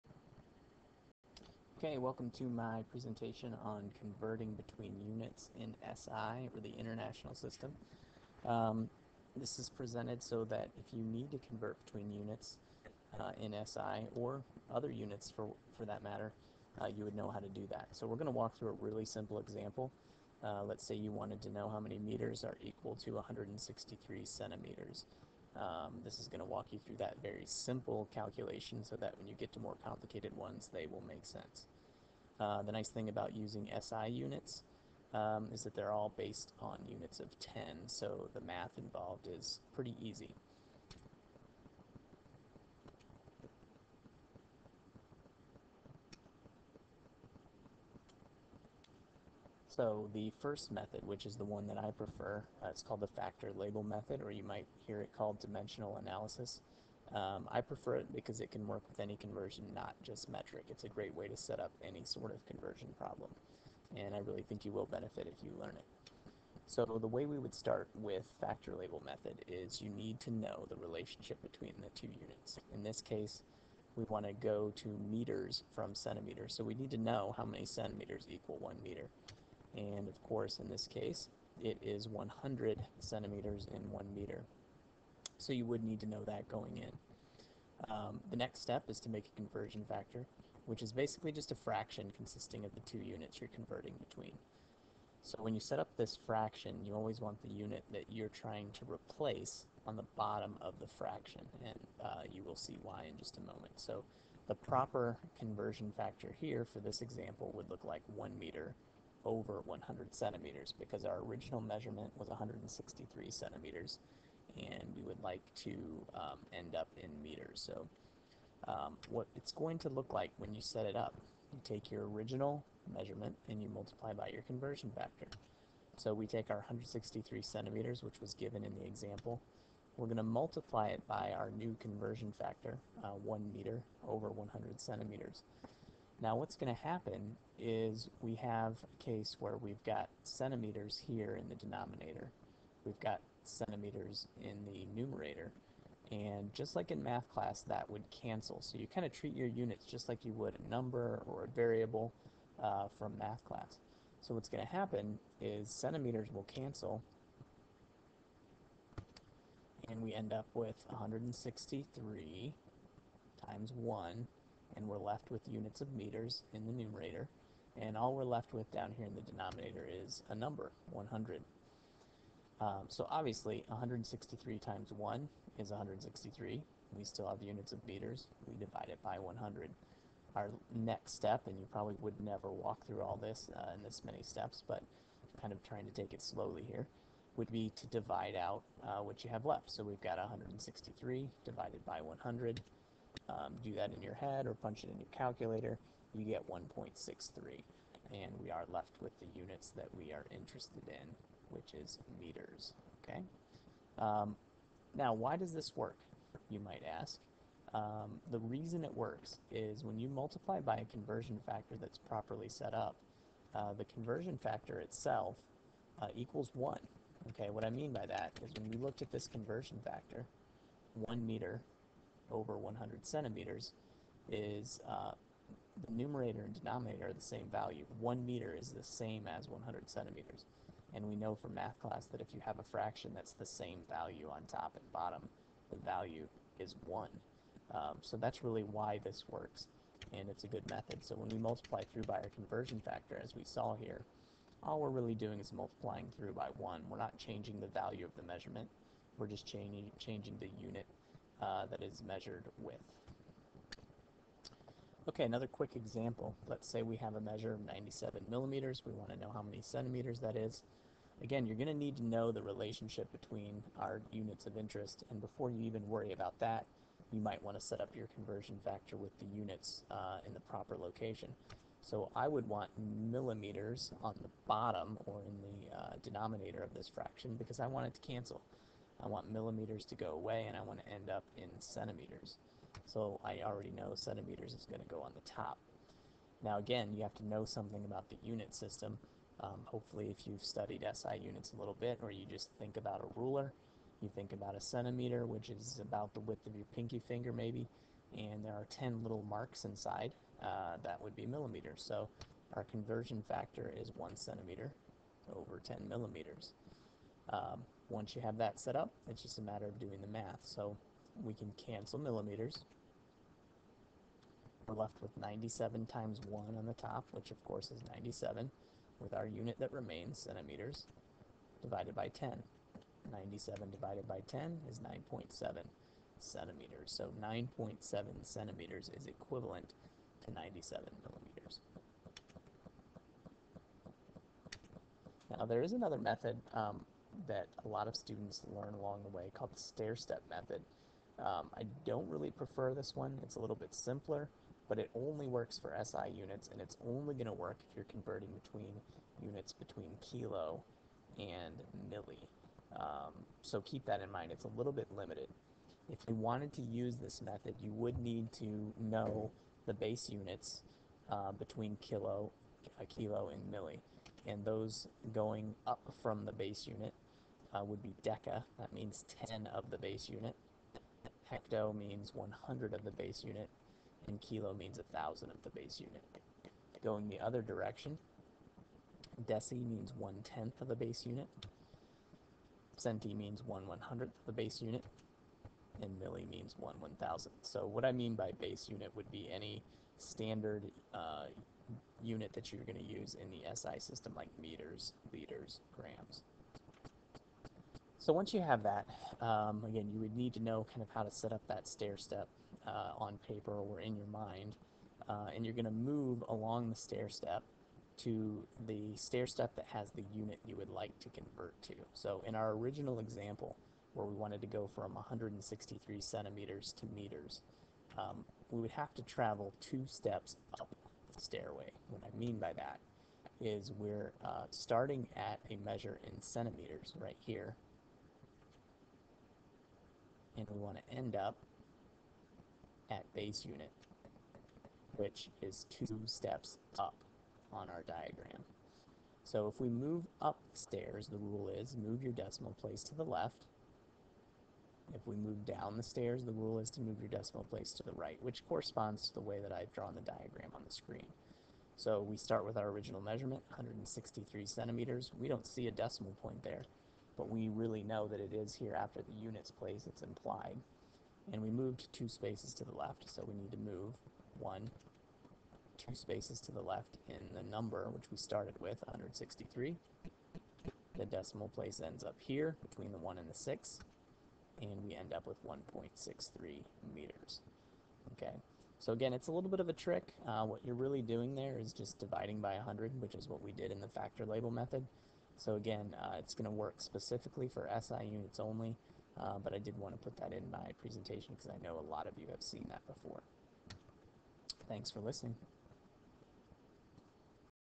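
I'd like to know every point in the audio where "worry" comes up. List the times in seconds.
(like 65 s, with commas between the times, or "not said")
265 s.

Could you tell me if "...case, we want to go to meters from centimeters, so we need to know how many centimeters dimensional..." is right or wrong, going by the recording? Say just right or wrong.
wrong.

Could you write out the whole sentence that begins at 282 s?
So I already know centimeters is going to go on the top.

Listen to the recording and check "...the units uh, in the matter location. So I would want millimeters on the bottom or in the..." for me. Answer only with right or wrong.
wrong.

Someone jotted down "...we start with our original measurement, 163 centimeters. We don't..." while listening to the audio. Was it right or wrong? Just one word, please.
right.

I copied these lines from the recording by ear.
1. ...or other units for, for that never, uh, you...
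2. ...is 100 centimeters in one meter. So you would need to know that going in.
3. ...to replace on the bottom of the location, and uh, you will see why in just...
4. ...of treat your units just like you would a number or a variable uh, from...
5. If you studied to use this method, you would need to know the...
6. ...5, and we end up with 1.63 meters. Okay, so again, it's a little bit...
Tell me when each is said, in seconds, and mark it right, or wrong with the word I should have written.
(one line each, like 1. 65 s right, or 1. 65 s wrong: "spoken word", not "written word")
1. 14 s wrong: "matter", not "never"
2. 81 s right
3. 98 s wrong: "fraction", not "location"
4. 149 s right
5. 355 s wrong: "wanted", not "studied"
6. 473 s wrong: "6", not "5".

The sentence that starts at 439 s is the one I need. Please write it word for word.
So if we move upstairs, the rule is move your decimal place to the left.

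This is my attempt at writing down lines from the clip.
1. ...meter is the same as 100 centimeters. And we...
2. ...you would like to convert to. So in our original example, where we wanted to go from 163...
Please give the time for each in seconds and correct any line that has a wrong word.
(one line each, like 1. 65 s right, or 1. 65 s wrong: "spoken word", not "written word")
1. 228 s right
2. 410 s right.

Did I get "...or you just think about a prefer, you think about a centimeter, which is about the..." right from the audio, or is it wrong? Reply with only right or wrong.
wrong.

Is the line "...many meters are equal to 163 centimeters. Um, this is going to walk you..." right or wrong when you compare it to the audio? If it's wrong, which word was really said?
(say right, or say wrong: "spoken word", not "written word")
right.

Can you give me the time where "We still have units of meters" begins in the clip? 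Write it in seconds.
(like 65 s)
176 s.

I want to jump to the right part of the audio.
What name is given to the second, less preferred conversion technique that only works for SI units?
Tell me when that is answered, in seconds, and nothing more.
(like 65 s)
339 s.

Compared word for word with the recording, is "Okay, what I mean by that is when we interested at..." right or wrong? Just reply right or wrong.
wrong.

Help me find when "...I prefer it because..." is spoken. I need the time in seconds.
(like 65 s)
57 s.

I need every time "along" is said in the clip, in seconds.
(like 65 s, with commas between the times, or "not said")
338 s, 406 s.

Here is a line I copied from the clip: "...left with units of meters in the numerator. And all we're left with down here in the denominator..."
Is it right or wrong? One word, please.
right.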